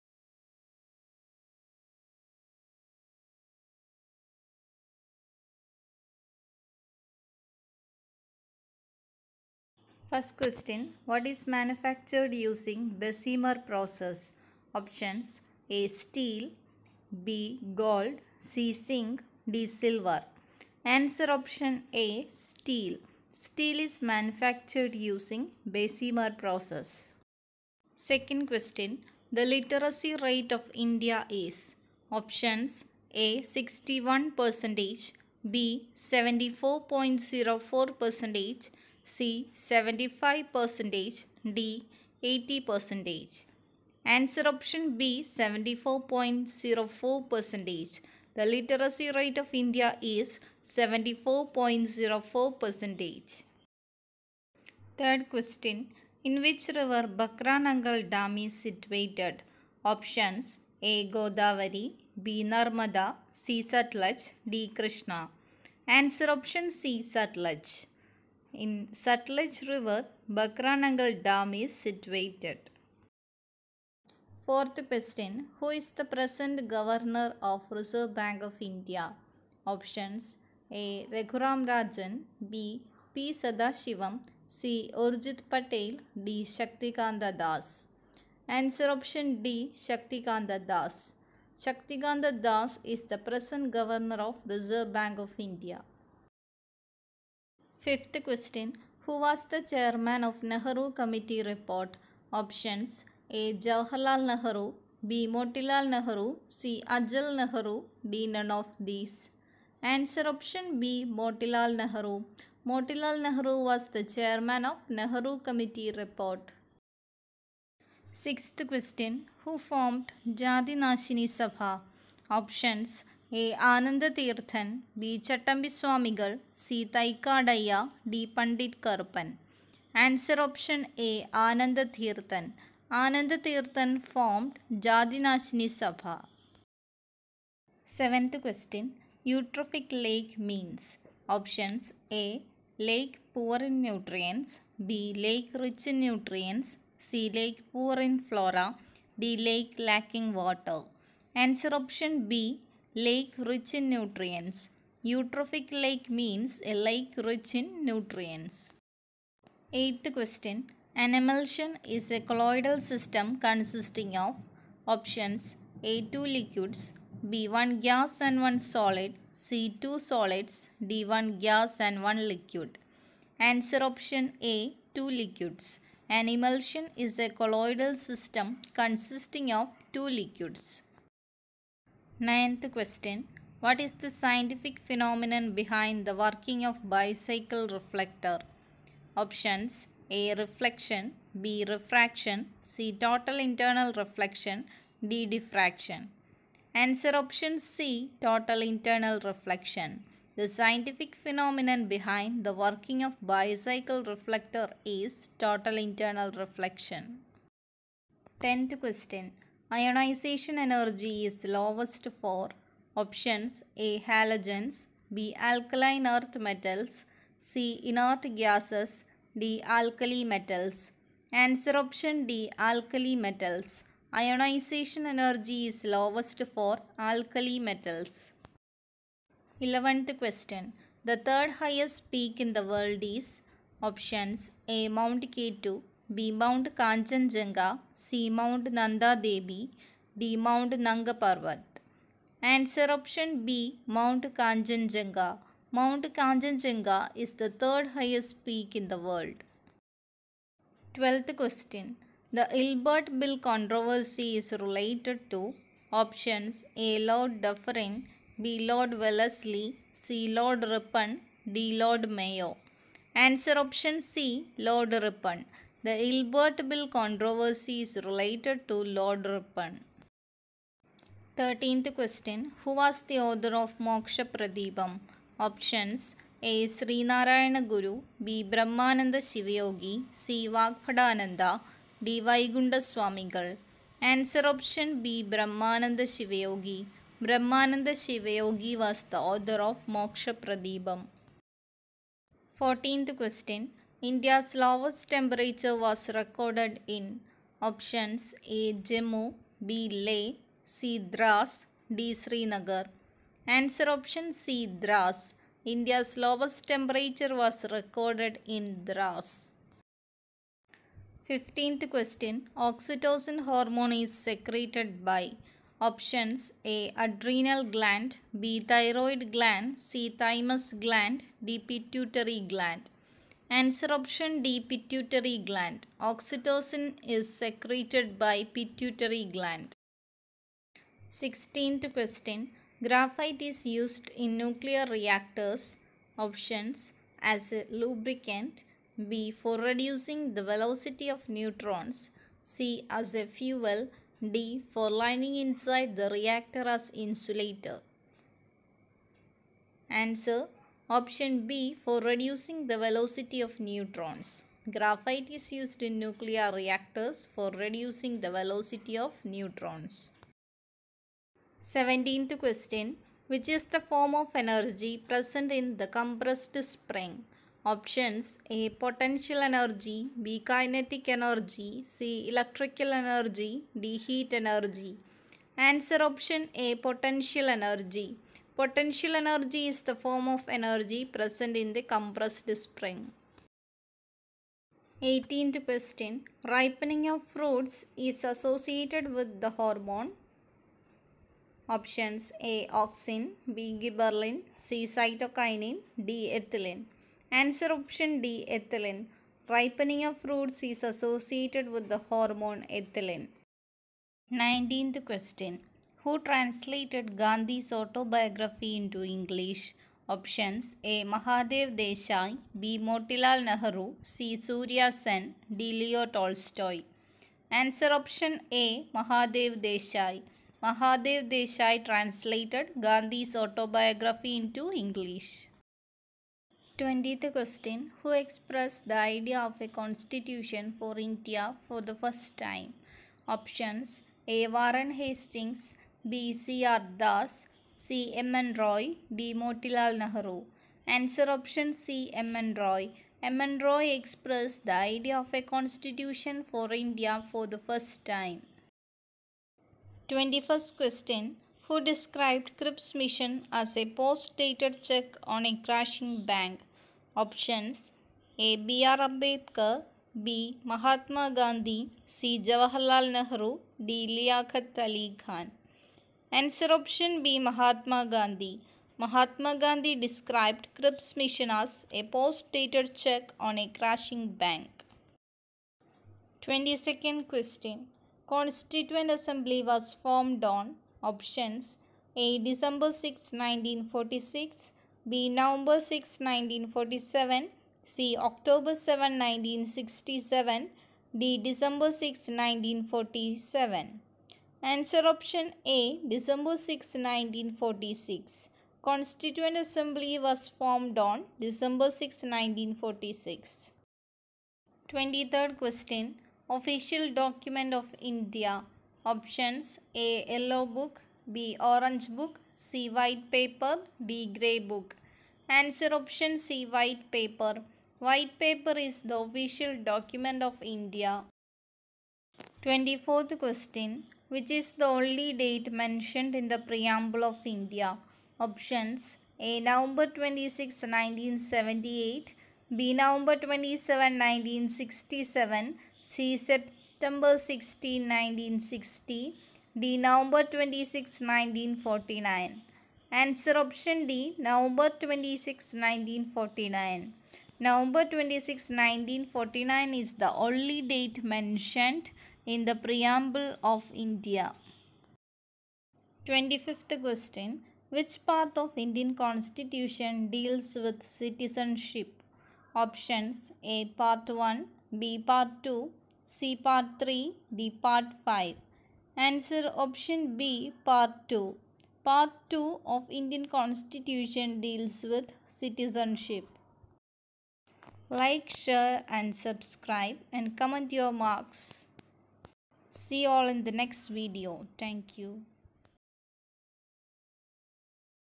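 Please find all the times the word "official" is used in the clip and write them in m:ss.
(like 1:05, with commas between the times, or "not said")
8:26, 8:39.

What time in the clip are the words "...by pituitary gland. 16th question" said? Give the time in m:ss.
5:28.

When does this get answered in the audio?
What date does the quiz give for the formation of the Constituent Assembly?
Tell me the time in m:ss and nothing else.
8:20.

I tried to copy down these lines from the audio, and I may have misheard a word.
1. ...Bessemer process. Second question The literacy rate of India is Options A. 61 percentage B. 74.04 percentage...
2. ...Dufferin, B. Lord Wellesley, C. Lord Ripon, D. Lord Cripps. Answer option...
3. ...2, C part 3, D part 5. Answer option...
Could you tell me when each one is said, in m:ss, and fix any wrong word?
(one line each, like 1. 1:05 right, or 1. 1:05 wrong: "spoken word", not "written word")
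1. 0:25 right
2. 4:17 wrong: "Mayo", not "Cripps"
3. 9:25 right.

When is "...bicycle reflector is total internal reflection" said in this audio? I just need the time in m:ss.
3:23.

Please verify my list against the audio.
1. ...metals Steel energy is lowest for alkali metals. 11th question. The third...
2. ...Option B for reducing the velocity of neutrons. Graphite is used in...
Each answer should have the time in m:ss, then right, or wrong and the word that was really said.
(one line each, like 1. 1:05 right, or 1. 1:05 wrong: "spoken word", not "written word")
1. 3:43 wrong: "Ionization", not "Steel"
2. 5:50 right.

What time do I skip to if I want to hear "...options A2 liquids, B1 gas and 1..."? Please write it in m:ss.
2:44.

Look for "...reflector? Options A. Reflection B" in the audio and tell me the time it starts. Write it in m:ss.
3:07.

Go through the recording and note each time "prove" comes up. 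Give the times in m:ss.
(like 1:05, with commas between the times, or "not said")
not said.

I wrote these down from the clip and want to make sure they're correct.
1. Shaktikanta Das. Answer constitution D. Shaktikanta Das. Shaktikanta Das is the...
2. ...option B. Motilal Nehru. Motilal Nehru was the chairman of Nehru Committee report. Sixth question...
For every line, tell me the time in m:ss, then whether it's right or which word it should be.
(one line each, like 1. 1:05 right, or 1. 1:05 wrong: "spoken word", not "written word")
1. 1:26 wrong: "option", not "constitution"
2. 1:50 right.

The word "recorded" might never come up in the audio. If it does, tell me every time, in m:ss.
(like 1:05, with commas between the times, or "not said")
4:56, 5:07.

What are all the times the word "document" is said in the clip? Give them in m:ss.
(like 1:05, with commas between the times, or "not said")
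8:27, 8:39.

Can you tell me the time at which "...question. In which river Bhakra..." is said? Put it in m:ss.
0:55.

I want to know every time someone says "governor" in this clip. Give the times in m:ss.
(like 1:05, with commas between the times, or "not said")
1:16, 1:33.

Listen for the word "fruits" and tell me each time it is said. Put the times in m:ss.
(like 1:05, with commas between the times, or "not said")
6:27, 6:40.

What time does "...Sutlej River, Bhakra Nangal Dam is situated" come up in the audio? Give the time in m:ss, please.
1:08.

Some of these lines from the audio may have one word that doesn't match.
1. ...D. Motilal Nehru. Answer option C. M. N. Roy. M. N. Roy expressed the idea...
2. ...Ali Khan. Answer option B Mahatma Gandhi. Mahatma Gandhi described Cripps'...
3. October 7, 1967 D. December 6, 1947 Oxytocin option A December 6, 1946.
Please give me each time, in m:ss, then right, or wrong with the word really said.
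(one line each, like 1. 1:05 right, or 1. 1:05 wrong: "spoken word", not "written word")
1. 7:19 right
2. 7:44 right
3. 8:08 wrong: "Answer", not "Oxytocin".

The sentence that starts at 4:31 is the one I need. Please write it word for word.
13th question Who was the author of Moksha Pradipam?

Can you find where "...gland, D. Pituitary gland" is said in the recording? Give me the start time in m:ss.
5:20.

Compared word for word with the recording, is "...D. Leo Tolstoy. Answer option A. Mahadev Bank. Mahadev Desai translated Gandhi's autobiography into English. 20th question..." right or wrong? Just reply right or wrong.
wrong.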